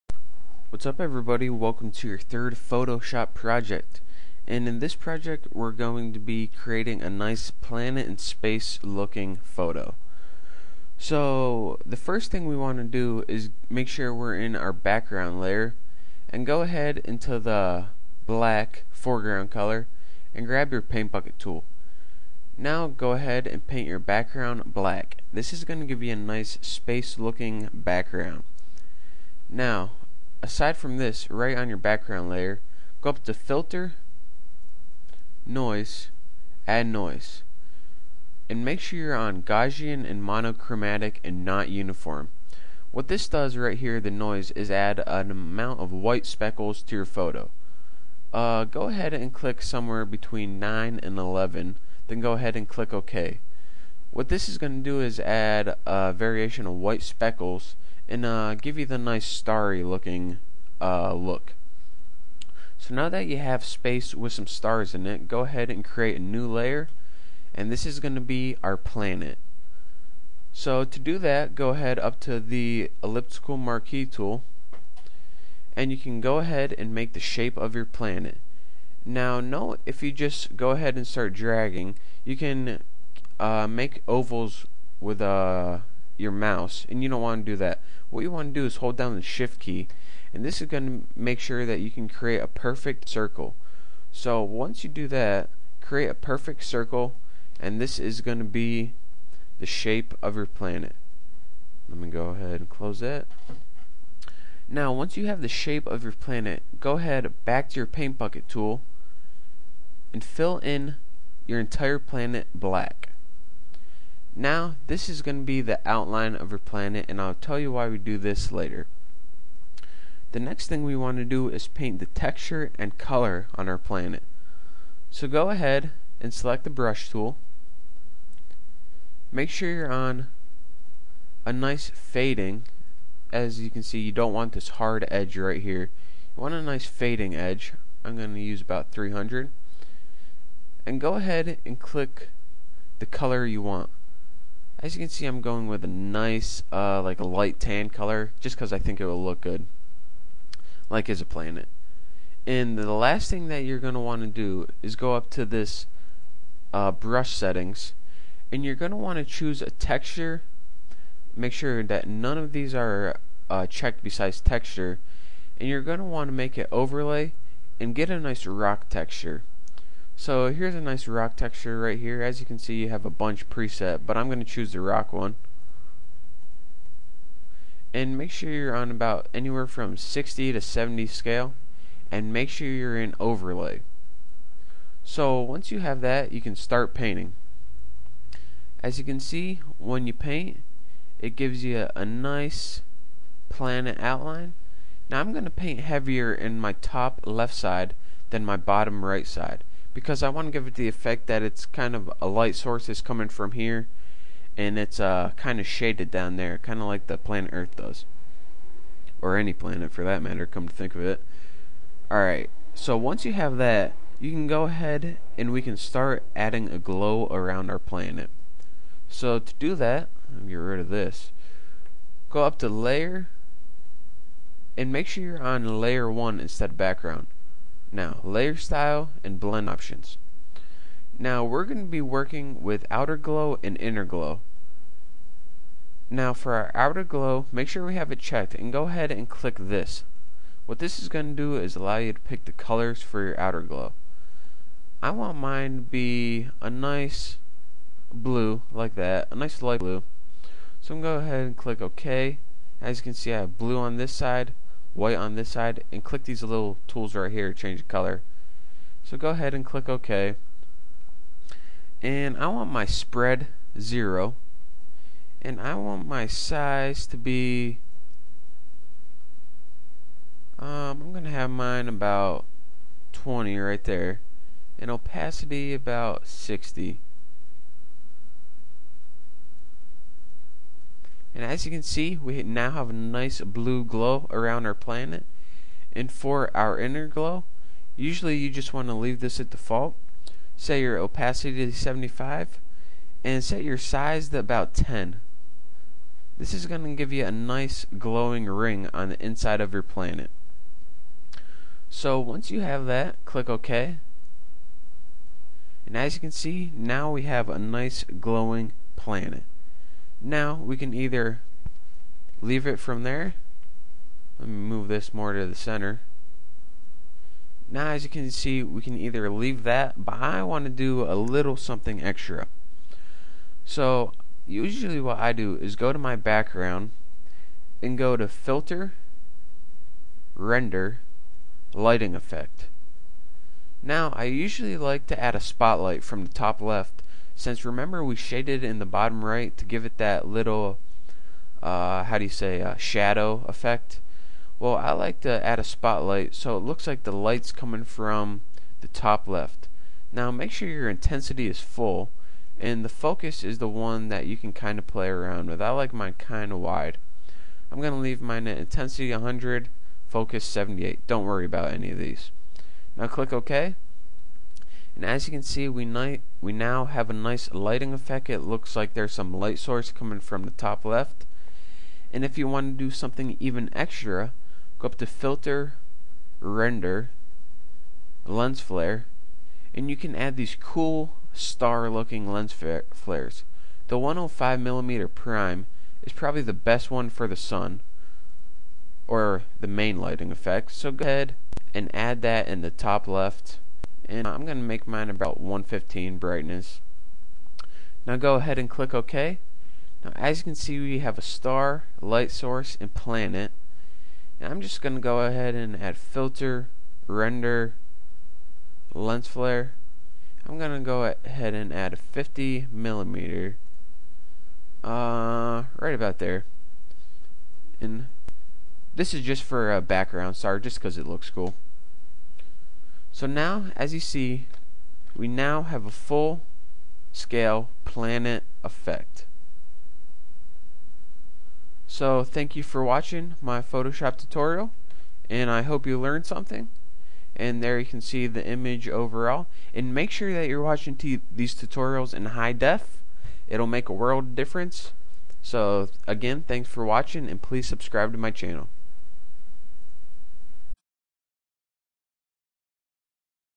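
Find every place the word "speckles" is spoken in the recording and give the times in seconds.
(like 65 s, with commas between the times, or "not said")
46 s, 57 s.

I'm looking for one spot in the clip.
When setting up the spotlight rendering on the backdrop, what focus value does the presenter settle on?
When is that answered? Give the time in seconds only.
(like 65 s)
360 s.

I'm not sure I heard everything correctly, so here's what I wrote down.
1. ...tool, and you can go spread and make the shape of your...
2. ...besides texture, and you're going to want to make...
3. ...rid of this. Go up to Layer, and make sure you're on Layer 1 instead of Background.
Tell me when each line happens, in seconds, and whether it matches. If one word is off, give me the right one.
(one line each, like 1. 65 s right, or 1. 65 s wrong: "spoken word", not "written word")
1. 74 s wrong: "ahead", not "spread"
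2. 164 s right
3. 220 s right.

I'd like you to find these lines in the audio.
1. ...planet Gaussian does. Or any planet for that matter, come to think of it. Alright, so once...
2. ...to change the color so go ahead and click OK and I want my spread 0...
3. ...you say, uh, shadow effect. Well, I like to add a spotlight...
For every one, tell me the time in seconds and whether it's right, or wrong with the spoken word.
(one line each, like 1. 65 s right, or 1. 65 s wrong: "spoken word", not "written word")
1. 207 s wrong: "Earth", not "Gaussian"
2. 257 s right
3. 342 s right.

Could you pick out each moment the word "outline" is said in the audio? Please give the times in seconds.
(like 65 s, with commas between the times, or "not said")
115 s, 193 s.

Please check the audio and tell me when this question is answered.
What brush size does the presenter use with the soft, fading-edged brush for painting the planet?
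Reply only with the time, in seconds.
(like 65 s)
138 s.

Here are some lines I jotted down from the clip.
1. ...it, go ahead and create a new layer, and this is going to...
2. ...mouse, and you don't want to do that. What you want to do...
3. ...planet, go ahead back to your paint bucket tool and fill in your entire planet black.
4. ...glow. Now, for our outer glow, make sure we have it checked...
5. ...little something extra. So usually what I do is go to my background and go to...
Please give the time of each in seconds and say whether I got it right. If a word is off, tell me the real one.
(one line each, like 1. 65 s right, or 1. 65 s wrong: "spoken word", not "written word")
1. 65 s right
2. 86 s right
3. 106 s right
4. 234 s right
5. 321 s right.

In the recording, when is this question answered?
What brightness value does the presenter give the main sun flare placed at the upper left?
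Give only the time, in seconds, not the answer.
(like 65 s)
395 s.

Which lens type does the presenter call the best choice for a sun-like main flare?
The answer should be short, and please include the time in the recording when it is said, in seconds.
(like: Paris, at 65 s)
105 millimeter prime, at 383 s.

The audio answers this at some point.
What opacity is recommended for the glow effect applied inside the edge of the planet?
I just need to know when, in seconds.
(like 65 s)
291 s.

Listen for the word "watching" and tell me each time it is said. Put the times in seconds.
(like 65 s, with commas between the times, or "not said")
432 s, 440 s, 446 s.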